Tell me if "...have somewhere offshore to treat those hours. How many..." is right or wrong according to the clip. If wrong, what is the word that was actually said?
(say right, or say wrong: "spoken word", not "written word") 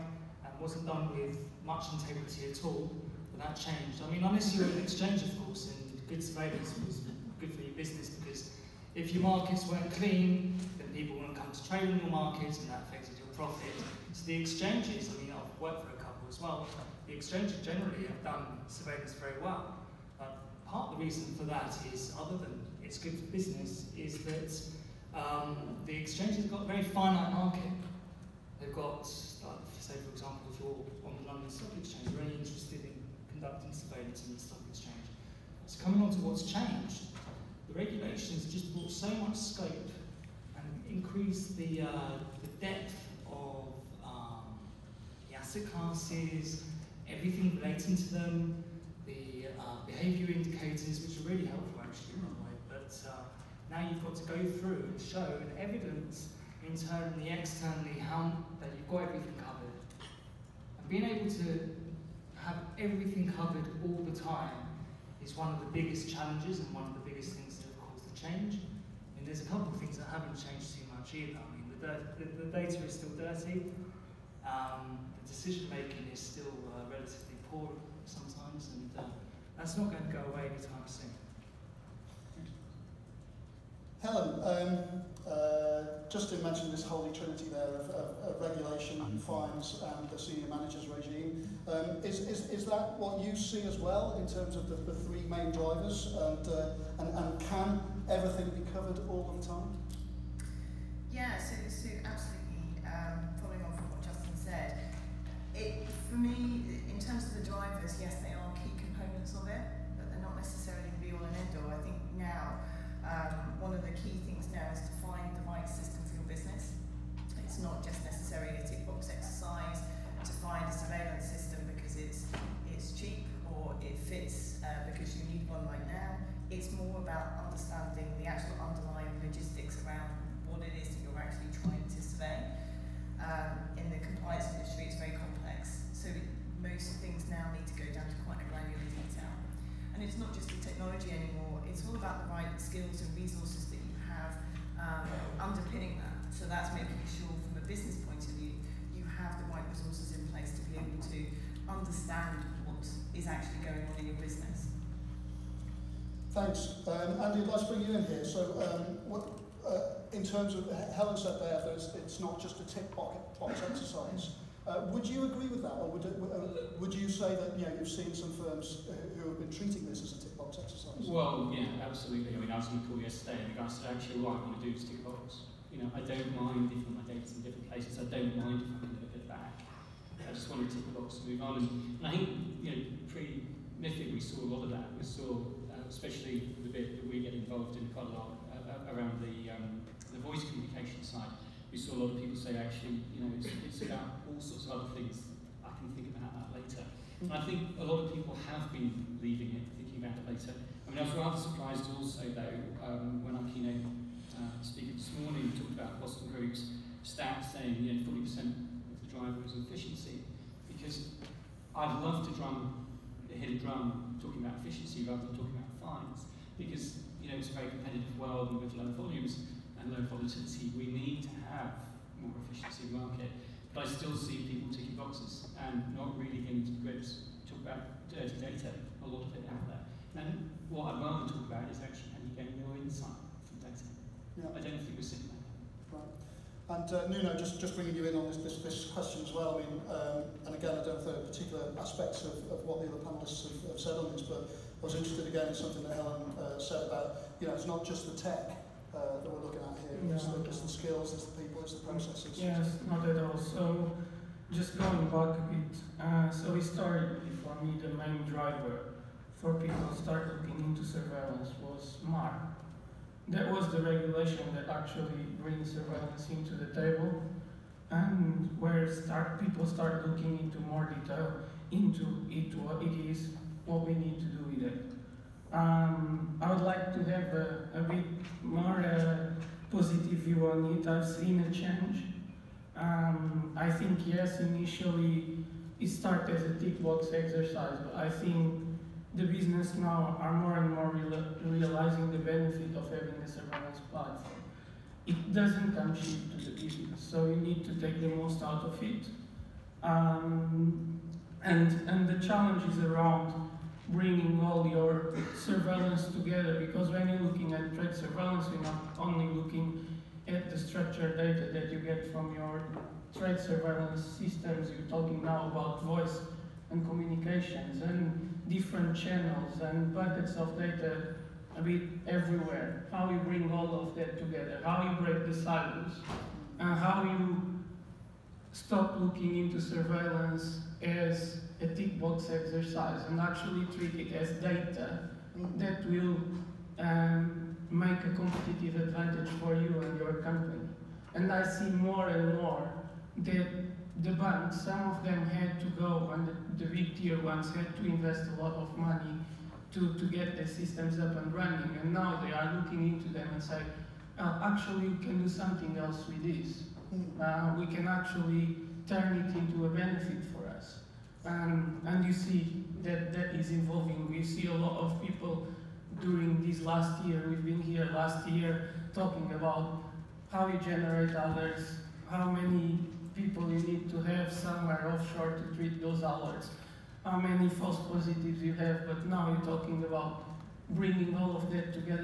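right.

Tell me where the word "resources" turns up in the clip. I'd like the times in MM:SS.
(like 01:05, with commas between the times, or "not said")
02:23, 02:29.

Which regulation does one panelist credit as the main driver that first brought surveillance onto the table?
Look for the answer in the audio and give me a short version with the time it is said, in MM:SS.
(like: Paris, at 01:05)
MAR, at 04:22.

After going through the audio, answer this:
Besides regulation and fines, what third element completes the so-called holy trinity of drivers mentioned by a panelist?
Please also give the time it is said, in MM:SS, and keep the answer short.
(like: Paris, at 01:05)
senior managers regime, at 01:30.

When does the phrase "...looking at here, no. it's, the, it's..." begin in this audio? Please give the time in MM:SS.
04:09.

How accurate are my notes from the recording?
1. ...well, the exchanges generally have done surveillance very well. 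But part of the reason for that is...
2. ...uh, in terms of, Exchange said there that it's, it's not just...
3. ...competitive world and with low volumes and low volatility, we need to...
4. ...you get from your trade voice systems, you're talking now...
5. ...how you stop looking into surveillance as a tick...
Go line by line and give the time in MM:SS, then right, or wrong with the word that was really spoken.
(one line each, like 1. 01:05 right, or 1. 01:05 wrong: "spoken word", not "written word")
1. 00:16 right
2. 02:39 wrong: "Helen", not "Exchange"
3. 03:37 right
4. 05:11 wrong: "surveillance", not "voice"
5. 05:26 right.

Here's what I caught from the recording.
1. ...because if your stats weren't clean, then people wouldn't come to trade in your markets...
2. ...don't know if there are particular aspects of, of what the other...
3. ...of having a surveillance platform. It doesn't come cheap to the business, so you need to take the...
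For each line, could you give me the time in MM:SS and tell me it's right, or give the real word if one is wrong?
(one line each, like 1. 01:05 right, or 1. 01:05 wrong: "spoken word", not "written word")
1. 00:08 wrong: "markets", not "stats"
2. 04:00 right
3. 04:52 right.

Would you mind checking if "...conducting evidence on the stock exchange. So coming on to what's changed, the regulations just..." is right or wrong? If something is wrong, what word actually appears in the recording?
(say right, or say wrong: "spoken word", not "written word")
wrong: "surveillance", not "evidence".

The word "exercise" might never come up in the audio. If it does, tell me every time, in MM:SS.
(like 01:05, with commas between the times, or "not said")
01:59, 02:43, 02:50, 04:47, 05:32.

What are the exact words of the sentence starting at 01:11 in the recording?
I mean, the, the, the data is still dirty.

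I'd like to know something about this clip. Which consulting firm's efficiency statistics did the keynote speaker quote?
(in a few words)
Boston Group.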